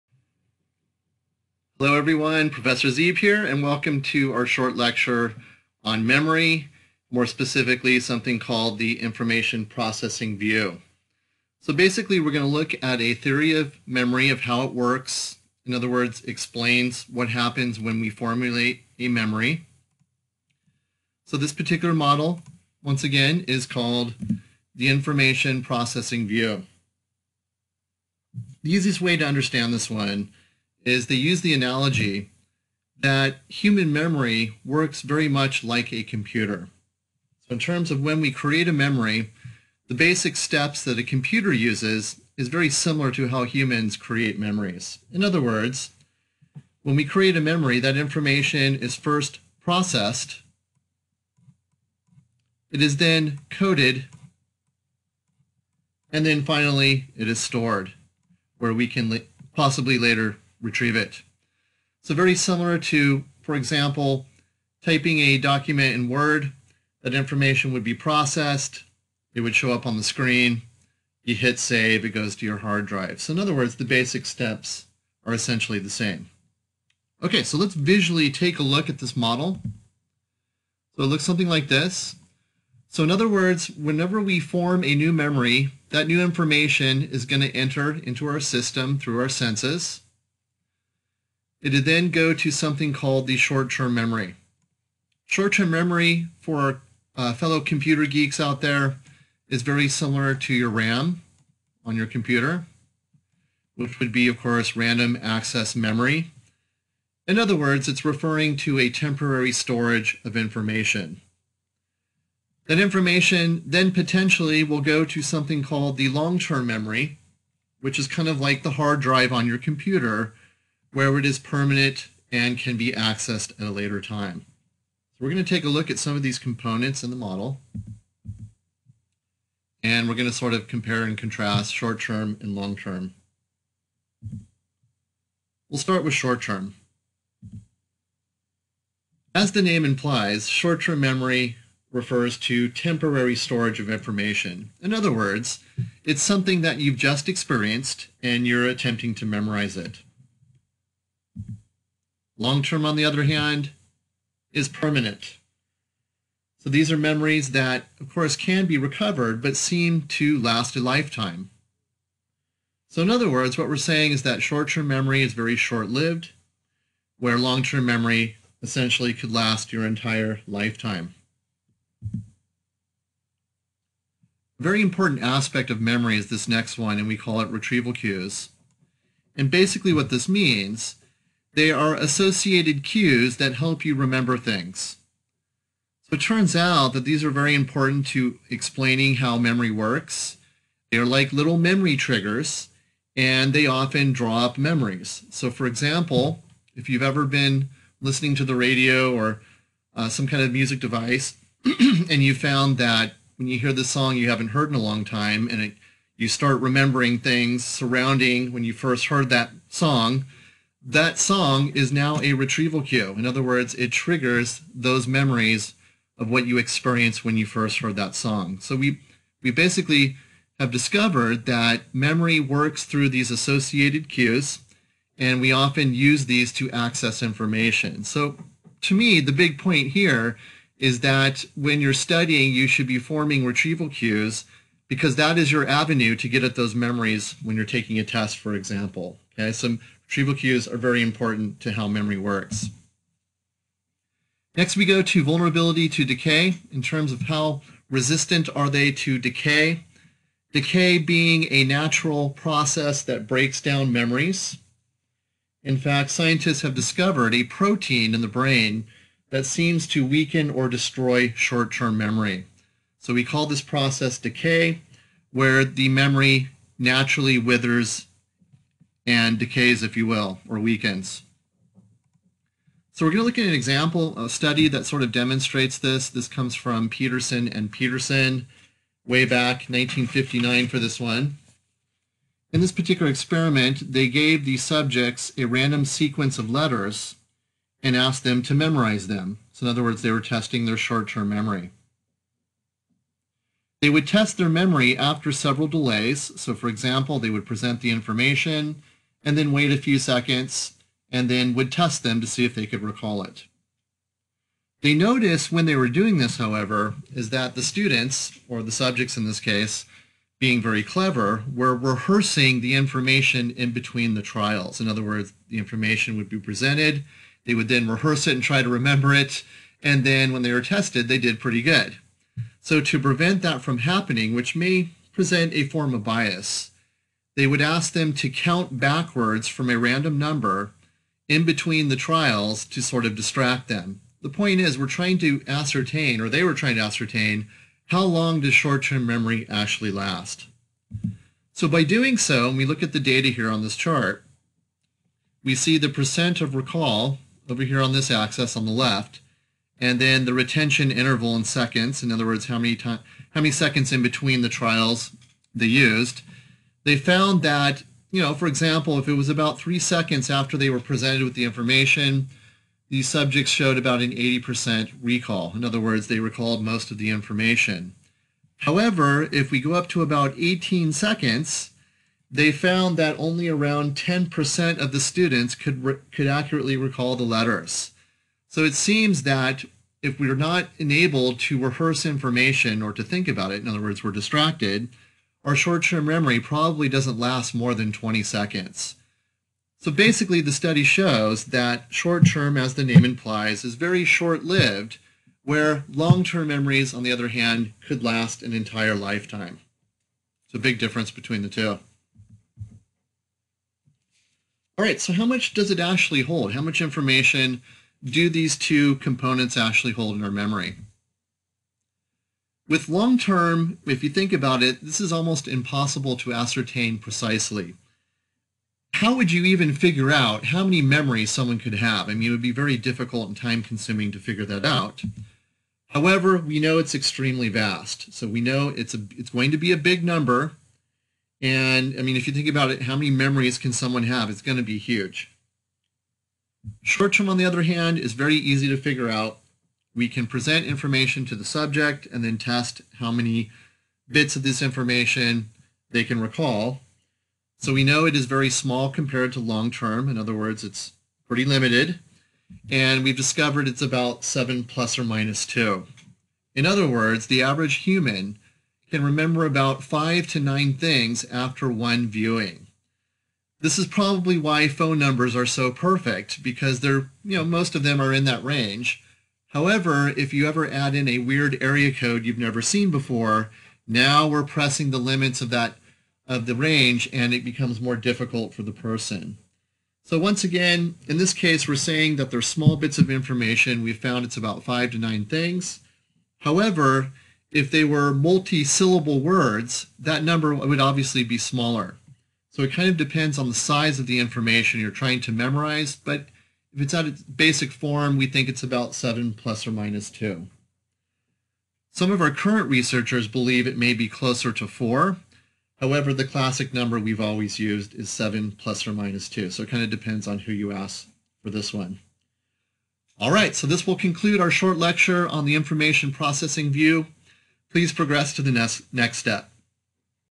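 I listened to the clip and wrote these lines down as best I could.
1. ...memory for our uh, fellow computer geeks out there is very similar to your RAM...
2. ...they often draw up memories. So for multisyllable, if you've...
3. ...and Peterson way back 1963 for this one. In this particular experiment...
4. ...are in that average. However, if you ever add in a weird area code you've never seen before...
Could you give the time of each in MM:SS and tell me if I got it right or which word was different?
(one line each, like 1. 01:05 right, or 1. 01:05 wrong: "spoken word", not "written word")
1. 01:35 right
2. 03:13 wrong: "example", not "multisyllable"
3. 04:37 wrong: "1959", not "1963"
4. 07:48 wrong: "range", not "average".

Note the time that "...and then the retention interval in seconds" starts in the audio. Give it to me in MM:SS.
05:49.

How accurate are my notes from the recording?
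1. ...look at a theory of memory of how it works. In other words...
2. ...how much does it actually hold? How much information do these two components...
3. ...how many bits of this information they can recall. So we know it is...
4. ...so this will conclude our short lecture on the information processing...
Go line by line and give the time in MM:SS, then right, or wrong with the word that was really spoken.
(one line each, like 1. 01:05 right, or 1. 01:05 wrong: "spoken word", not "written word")
1. 00:12 right
2. 06:45 right
3. 07:22 right
4. 08:33 right.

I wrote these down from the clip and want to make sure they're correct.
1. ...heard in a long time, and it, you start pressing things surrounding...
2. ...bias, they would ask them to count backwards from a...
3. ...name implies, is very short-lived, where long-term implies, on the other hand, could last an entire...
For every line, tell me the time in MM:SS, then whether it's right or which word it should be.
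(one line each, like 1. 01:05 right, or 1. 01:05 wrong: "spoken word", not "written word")
1. 03:24 wrong: "remembering", not "pressing"
2. 05:26 right
3. 06:32 wrong: "memories", not "implies".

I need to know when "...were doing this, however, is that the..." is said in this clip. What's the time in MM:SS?
05:05.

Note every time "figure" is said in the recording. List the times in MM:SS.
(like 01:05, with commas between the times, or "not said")
06:59, 07:04, 07:18.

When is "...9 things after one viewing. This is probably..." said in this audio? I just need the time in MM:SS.
07:40.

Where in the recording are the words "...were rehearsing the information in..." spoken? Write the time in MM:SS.
05:11.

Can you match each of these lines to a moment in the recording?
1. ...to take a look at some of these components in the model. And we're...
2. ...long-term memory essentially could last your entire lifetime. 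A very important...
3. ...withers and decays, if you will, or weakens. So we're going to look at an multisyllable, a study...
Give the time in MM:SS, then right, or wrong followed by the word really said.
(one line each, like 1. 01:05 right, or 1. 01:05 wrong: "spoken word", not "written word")
1. 02:05 right
2. 02:47 right
3. 04:27 wrong: "example", not "multisyllable".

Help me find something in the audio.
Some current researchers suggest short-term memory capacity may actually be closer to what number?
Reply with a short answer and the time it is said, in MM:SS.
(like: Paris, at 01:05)
4, at 08:24.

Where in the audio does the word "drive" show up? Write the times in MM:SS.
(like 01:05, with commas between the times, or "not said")
01:12, 01:59.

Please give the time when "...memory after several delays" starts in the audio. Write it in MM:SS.
04:54.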